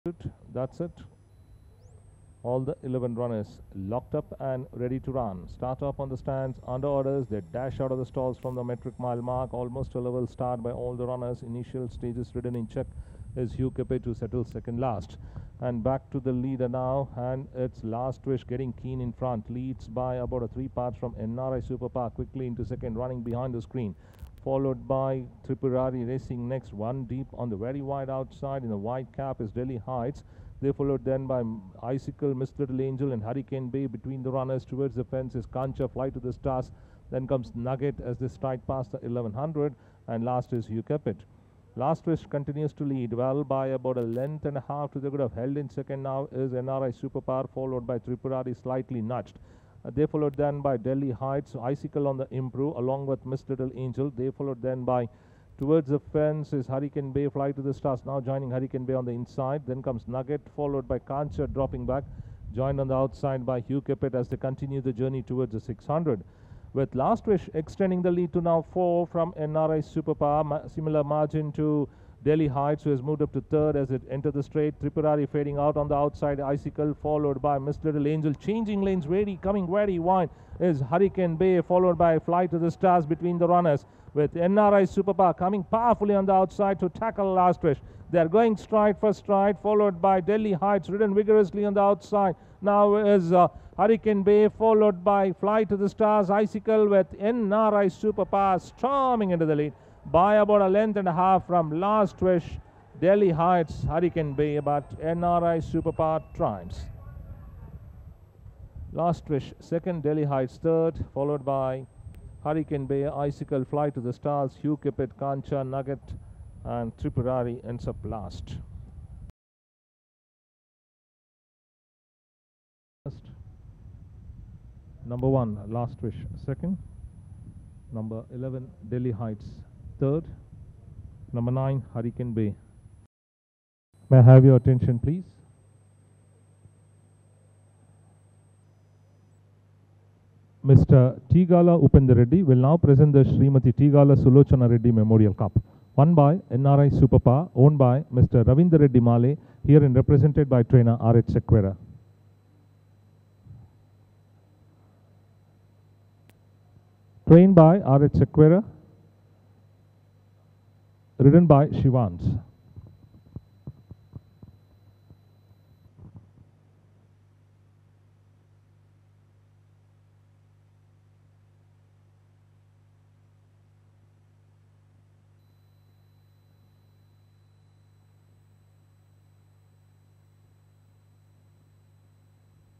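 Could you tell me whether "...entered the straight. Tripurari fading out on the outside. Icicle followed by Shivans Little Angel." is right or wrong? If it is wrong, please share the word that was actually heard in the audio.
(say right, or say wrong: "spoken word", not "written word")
wrong: "Miss", not "Shivans".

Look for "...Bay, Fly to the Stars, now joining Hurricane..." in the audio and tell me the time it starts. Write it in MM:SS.
00:57.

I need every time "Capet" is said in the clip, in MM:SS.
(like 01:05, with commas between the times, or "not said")
00:13, 01:03, 01:54.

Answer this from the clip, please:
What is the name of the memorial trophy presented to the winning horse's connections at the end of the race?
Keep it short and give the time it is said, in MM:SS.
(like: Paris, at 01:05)
Srimati Tigala Sulochana Reddy Memorial Cup, at 02:23.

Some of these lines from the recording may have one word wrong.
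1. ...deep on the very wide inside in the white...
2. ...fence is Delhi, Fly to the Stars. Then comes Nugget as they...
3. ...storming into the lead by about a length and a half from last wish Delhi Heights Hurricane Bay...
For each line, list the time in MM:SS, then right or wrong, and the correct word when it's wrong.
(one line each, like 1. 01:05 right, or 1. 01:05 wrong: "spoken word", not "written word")
1. 00:27 wrong: "outside", not "inside"
2. 00:35 wrong: "Kancha", not "Delhi"
3. 01:38 right.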